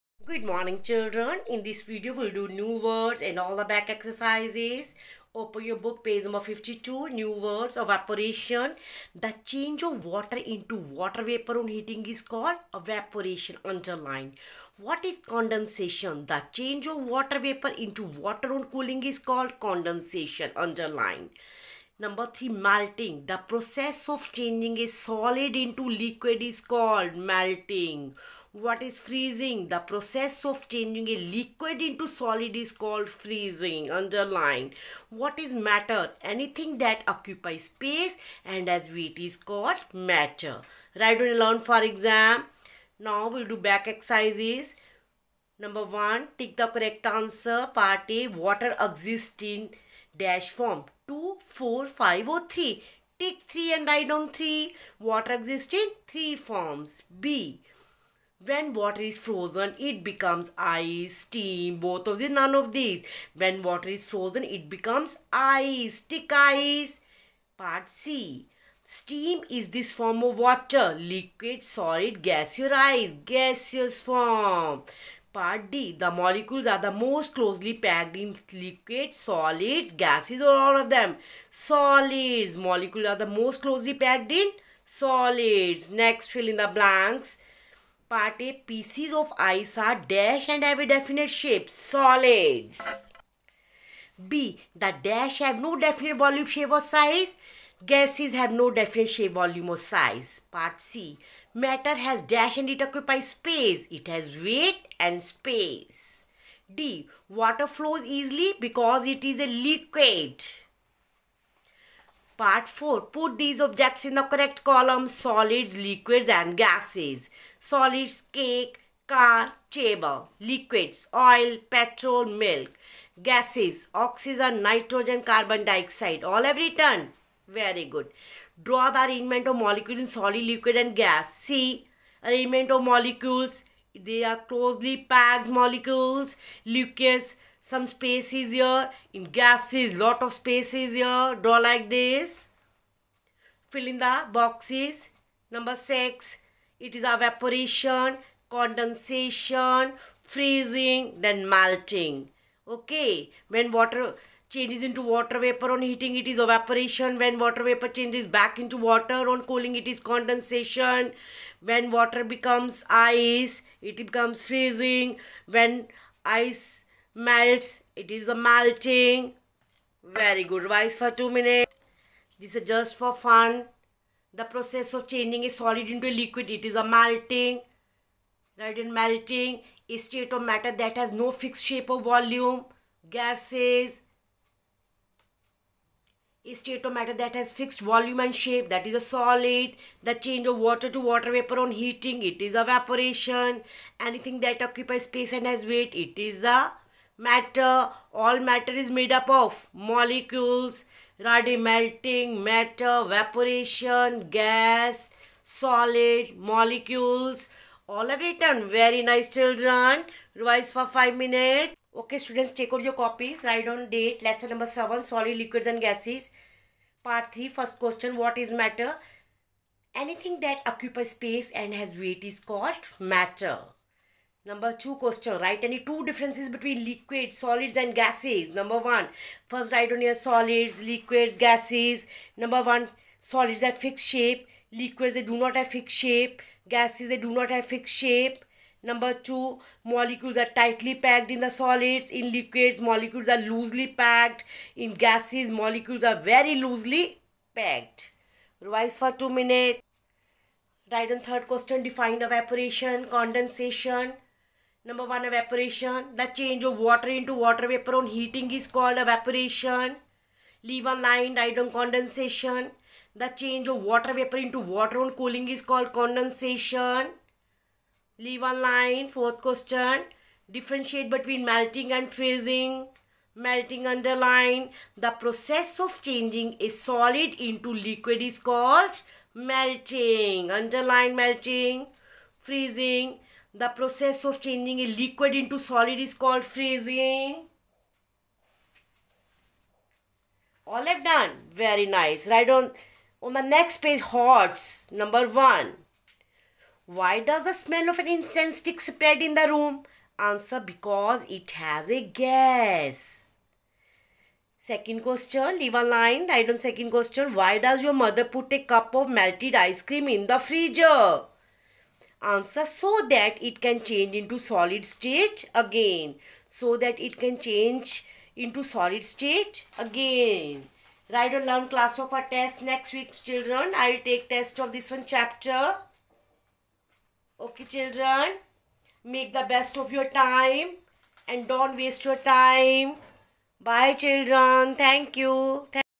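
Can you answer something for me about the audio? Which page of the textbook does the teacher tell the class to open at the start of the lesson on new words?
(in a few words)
52.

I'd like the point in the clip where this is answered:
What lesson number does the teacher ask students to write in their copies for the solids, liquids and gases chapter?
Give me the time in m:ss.
3:34.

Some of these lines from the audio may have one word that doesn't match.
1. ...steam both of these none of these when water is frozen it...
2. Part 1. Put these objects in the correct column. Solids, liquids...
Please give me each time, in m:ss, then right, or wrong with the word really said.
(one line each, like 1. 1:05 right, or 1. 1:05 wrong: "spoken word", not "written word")
1. 1:01 right
2. 1:52 wrong: "4", not "1".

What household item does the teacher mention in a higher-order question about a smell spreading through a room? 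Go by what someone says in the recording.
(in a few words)
incense stick.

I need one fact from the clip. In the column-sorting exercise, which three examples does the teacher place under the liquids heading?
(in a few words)
oil, petrol, milk.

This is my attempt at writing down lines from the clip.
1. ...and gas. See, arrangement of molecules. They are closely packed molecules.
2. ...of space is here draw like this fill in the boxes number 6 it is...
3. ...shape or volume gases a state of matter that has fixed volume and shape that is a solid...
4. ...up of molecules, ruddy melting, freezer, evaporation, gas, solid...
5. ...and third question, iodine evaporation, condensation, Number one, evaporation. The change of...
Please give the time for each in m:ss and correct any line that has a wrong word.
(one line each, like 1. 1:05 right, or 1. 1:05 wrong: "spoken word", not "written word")
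1. 2:10 right
2. 2:20 right
3. 3:01 right
4. 3:19 wrong: "matter", not "freezer"
5. 4:11 wrong: "define", not "iodine".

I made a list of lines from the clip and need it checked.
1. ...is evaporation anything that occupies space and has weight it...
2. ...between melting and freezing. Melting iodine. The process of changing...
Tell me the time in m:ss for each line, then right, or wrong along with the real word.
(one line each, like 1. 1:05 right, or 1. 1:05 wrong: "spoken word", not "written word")
1. 3:12 right
2. 4:31 wrong: "underline", not "iodine".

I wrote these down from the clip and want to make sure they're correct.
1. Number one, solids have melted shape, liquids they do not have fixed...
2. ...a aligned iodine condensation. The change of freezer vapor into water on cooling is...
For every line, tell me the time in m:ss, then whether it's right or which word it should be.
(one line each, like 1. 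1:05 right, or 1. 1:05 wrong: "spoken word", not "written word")
1. 3:52 wrong: "fixed", not "melted"
2. 4:20 wrong: "water", not "freezer".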